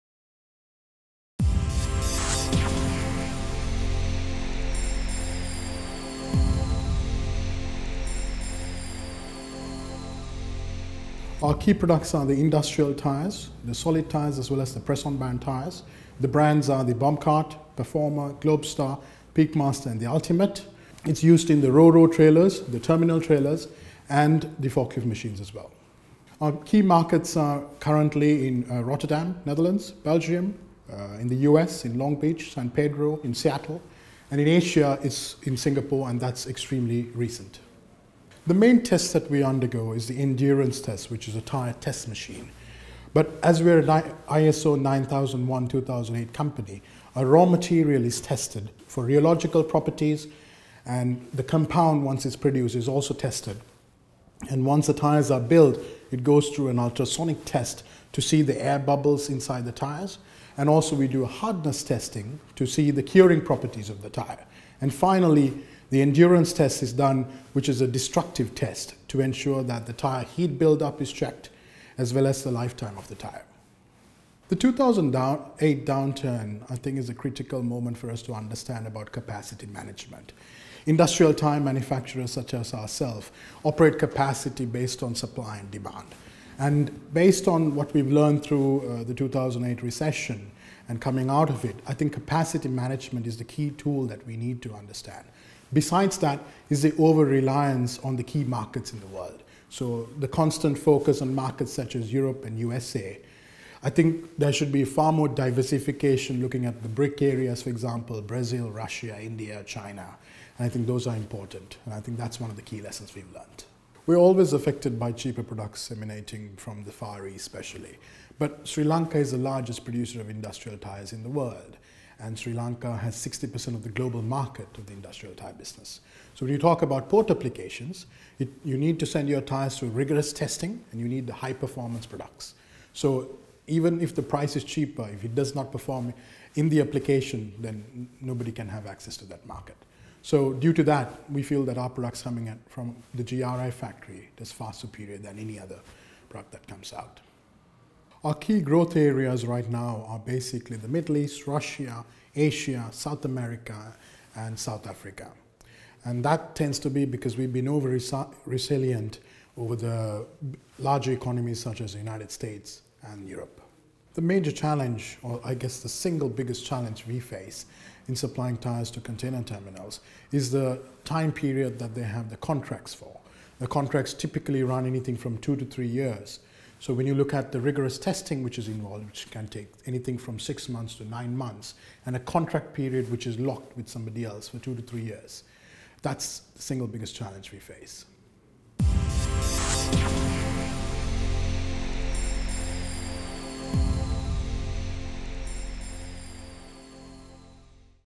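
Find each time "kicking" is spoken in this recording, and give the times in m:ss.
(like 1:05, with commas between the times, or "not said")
not said.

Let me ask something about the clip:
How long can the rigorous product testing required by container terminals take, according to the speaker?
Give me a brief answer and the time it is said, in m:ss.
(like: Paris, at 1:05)
6 to 9 months, at 3:00.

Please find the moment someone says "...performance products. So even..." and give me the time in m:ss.
2:11.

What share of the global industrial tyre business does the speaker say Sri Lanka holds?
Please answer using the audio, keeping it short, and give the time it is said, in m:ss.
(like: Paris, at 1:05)
60%, at 2:03.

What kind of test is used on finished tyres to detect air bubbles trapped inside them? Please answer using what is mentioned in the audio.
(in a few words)
Ultrasonic test.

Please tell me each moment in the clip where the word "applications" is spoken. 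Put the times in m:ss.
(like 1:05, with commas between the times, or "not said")
2:07, 2:16.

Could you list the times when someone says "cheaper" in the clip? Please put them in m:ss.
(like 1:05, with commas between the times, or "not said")
1:55, 2:14.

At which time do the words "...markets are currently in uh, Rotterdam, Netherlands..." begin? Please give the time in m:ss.
0:26.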